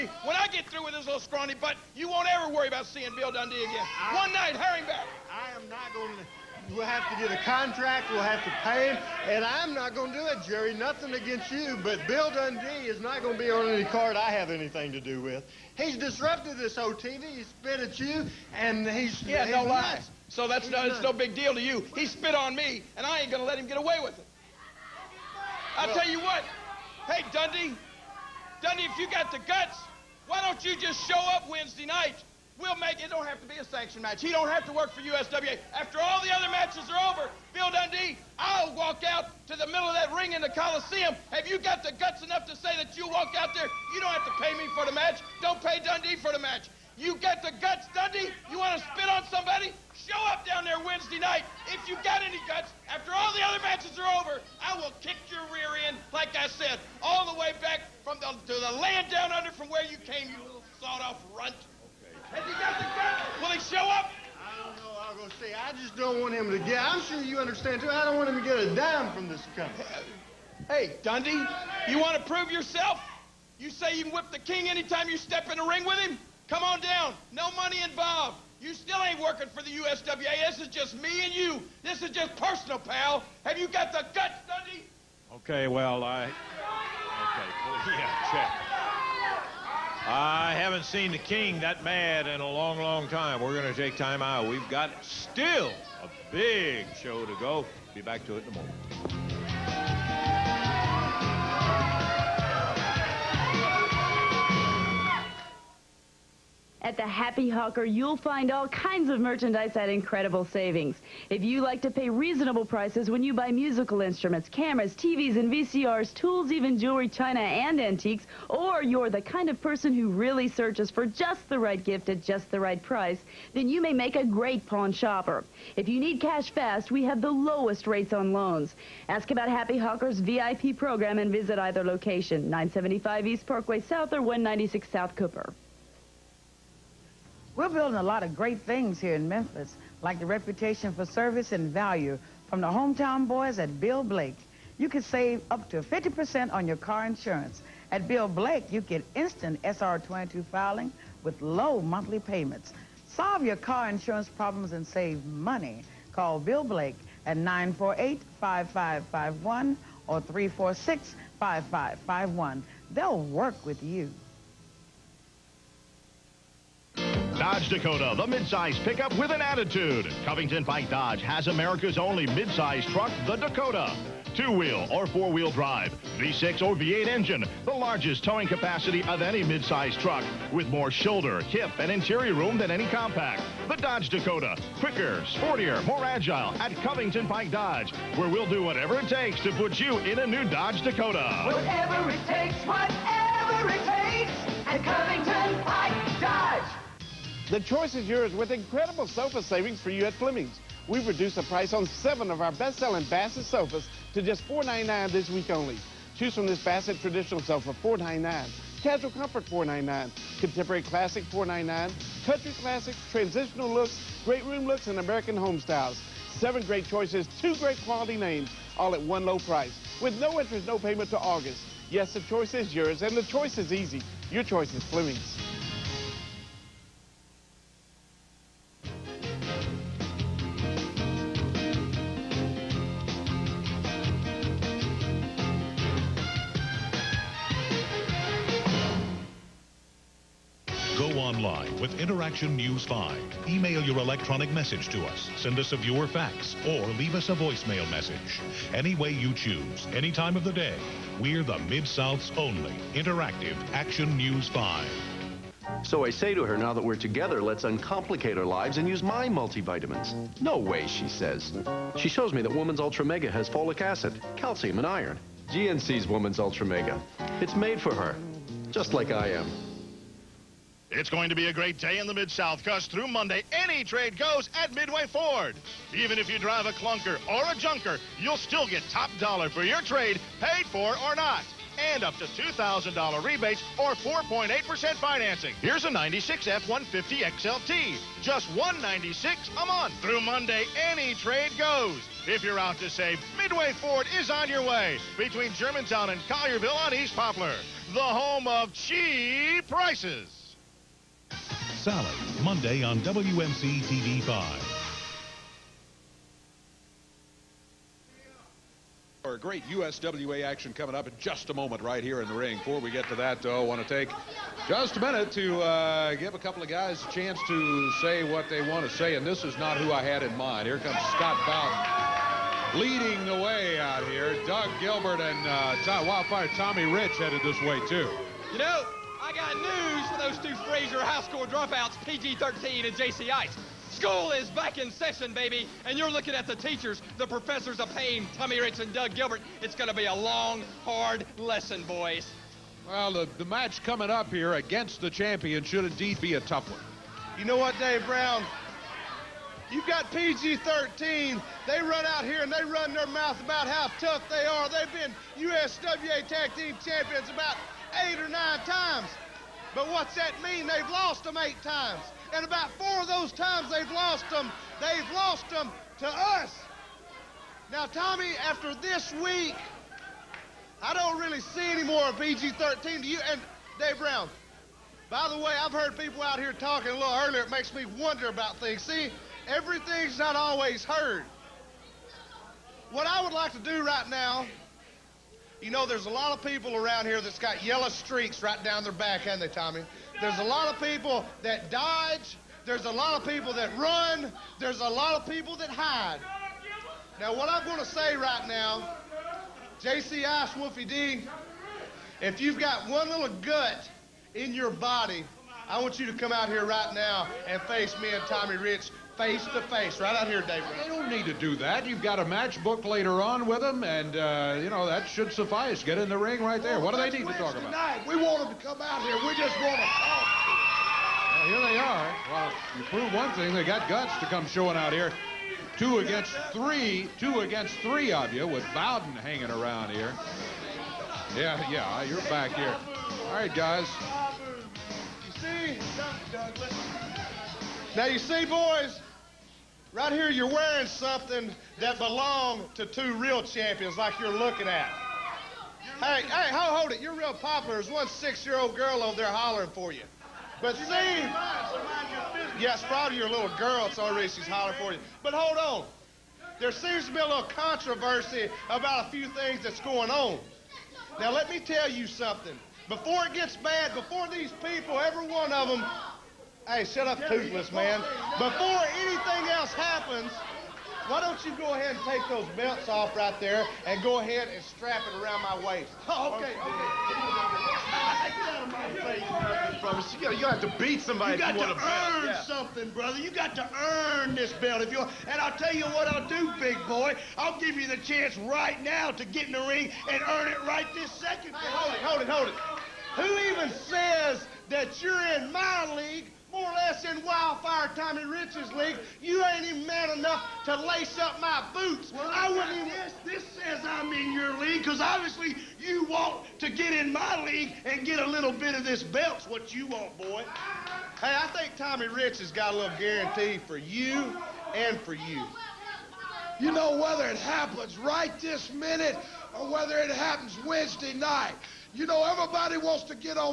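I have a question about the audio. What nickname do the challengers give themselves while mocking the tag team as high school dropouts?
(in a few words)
professors of pain.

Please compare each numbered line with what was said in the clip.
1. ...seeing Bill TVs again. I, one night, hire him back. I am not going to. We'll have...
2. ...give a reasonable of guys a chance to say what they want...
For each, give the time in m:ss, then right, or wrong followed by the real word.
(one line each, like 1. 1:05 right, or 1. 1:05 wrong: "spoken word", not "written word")
1. 0:02 wrong: "Dundee", not "TVs"
2. 5:16 wrong: "couple", not "reasonable".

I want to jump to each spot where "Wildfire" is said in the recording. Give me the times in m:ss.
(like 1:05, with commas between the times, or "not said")
5:26, 8:17.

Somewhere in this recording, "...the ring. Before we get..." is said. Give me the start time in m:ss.
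5:12.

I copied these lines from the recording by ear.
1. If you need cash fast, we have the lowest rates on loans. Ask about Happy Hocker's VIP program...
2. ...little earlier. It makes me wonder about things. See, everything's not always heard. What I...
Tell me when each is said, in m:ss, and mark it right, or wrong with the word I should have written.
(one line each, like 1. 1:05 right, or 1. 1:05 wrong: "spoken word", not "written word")
1. 2:05 right
2. 6:16 right.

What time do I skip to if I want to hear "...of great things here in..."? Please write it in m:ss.
2:18.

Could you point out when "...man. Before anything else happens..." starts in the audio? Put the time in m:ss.
7:47.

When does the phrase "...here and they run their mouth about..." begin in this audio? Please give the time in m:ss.
5:52.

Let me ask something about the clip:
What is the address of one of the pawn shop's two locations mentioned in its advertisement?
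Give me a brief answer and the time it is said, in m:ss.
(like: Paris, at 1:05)
196 South Cooper, at 2:14.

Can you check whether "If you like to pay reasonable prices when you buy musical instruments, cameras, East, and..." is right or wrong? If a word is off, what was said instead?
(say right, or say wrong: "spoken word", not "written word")
wrong: "TVs", not "East".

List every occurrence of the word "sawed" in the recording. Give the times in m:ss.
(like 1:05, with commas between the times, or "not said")
1:00.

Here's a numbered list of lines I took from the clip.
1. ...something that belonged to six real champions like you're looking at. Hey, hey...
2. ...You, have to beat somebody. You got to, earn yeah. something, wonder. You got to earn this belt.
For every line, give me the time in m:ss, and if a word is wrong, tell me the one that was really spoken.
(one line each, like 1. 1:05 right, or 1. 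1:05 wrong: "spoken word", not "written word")
1. 7:20 wrong: "two", not "six"
2. 8:00 wrong: "brother", not "wonder".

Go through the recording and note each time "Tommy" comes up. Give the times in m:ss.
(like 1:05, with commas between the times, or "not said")
5:26, 5:38, 6:07, 6:29, 6:48, 8:17, 8:31.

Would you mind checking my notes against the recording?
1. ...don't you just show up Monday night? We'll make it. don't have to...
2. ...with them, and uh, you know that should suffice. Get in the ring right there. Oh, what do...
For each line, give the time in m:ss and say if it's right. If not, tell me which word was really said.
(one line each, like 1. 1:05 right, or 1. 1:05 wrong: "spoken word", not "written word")
1. 0:30 wrong: "Wednesday", not "Monday"
2. 6:53 right.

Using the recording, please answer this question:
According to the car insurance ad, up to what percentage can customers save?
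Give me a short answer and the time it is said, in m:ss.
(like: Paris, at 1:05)
50%, at 2:25.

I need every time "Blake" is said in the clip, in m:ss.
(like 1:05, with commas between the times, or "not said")
2:24, 2:28, 2:36.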